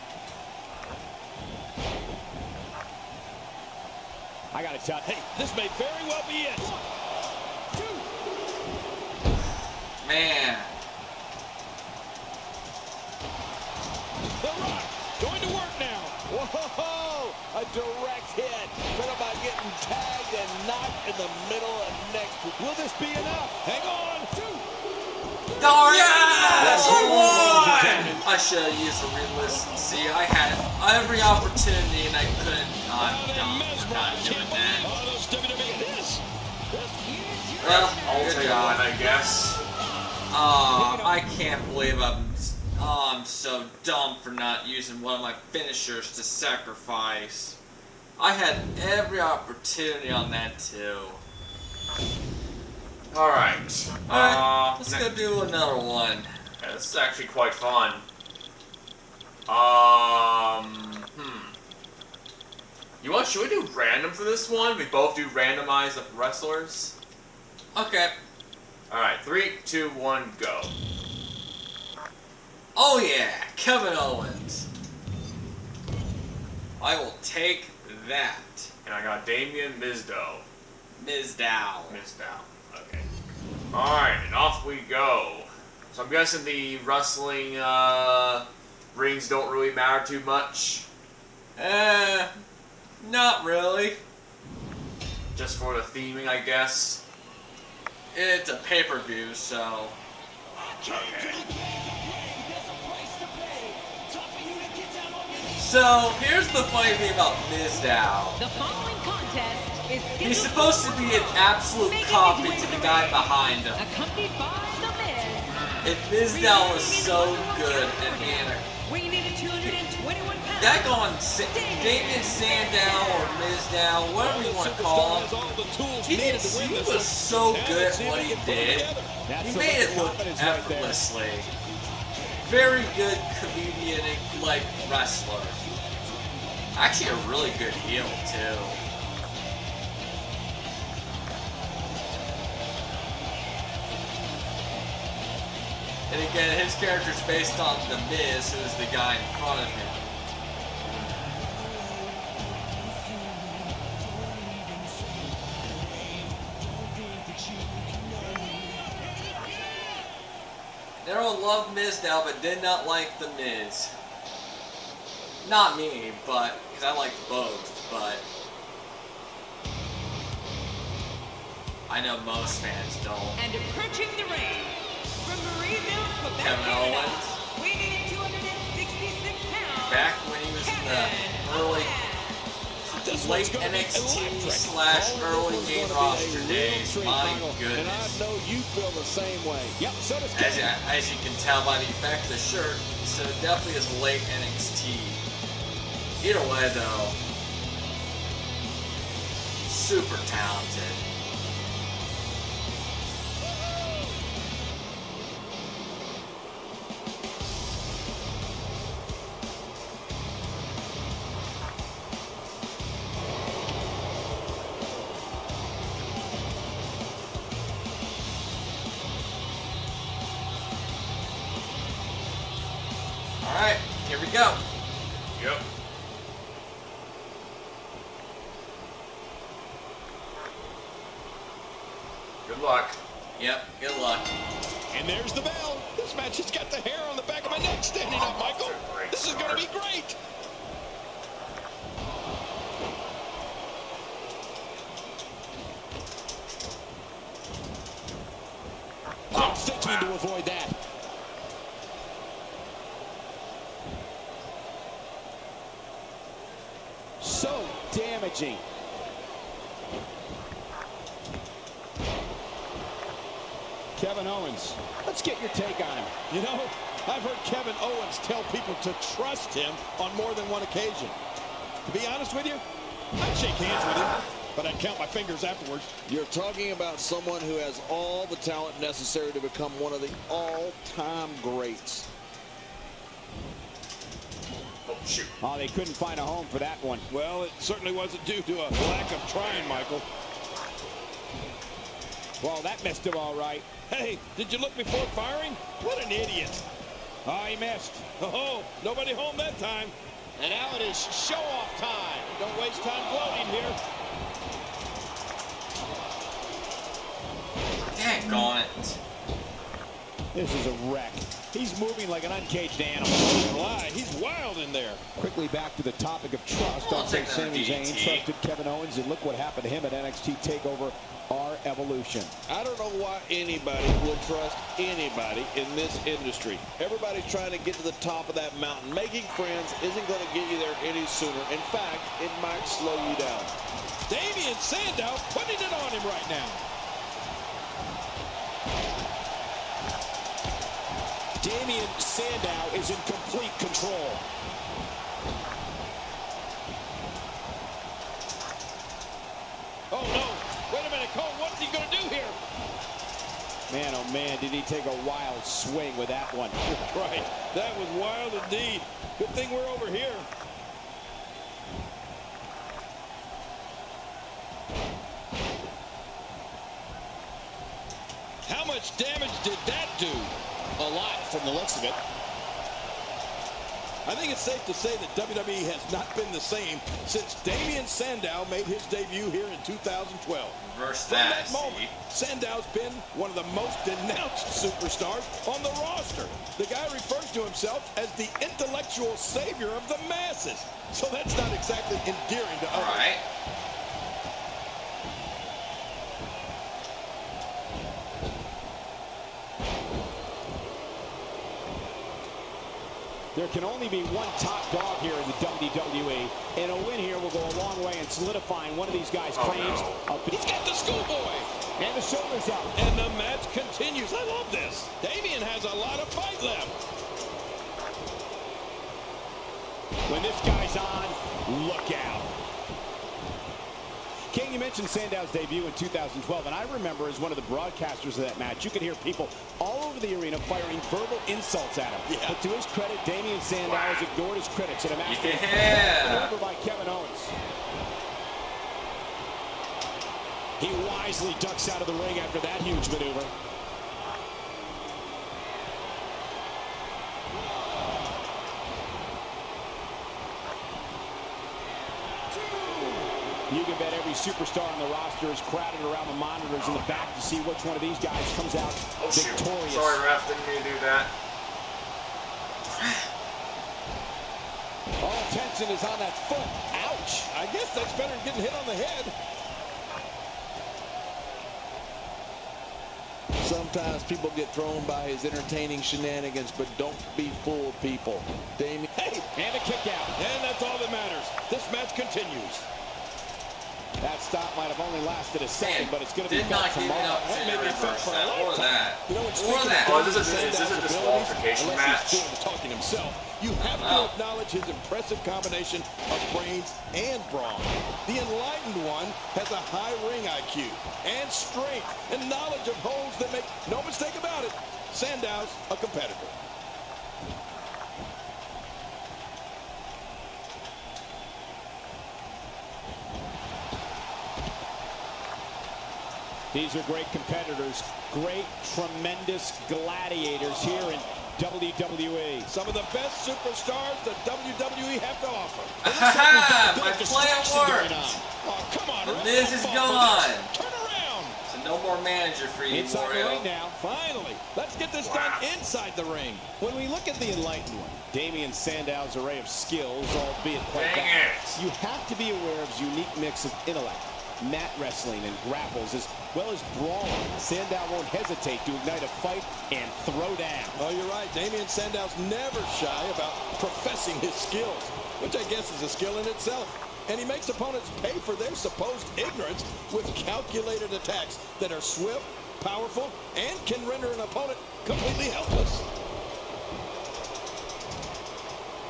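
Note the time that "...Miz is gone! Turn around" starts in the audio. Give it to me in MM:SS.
08:49.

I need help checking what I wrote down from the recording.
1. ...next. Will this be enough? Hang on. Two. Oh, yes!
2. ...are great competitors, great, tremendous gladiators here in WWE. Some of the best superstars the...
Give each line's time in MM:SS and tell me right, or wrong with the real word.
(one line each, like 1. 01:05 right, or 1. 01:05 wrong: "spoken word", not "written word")
1. 00:22 right
2. 08:36 right.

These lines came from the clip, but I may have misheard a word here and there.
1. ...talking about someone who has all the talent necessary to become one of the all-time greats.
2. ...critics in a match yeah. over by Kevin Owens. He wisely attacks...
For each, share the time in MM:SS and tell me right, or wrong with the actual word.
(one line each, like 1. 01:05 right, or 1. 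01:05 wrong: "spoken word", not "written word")
1. 04:36 right
2. 07:14 wrong: "ducks", not "attacks".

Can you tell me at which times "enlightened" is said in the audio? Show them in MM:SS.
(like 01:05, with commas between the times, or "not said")
08:18, 08:57.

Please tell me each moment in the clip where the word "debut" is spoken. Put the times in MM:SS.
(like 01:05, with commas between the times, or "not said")
06:18, 07:05.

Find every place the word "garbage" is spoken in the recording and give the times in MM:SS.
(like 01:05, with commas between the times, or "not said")
not said.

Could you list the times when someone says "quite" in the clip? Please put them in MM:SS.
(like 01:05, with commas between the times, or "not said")
00:57, 09:00.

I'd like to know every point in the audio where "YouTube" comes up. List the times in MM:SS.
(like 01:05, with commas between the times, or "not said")
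not said.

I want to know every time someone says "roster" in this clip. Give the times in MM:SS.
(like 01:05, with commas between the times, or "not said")
03:05, 06:25, 07:34.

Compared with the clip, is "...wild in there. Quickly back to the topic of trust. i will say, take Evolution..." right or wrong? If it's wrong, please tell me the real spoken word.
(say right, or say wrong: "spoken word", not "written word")
wrong: "Sami", not "Evolution".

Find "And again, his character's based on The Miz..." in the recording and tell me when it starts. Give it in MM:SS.
02:26.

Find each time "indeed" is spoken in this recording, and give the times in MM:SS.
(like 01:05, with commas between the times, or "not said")
05:58.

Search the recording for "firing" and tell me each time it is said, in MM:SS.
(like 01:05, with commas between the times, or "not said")
04:55, 07:10.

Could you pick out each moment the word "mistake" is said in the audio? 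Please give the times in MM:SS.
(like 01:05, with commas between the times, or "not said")
08:23.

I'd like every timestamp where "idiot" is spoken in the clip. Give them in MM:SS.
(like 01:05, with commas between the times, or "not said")
04:56.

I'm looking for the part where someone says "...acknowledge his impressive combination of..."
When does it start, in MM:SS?
08:14.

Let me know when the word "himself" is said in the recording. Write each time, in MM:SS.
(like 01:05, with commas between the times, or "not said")
06:27, 08:12.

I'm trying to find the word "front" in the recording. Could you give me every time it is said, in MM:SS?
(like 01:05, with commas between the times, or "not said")
02:29.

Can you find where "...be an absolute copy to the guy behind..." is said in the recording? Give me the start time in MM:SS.
01:50.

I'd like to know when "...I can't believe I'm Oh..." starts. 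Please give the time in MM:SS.
00:41.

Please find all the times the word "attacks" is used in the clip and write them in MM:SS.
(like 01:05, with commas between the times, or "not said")
09:20.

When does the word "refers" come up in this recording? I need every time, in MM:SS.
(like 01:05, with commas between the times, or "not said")
06:26.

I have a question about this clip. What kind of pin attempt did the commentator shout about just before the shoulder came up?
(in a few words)
Schoolboy.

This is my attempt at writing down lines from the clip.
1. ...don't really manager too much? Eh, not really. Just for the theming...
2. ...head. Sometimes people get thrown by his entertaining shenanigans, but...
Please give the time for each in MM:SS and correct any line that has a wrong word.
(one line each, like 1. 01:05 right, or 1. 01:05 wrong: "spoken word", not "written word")
1. 01:29 wrong: "matter", not "manager"
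2. 07:48 right.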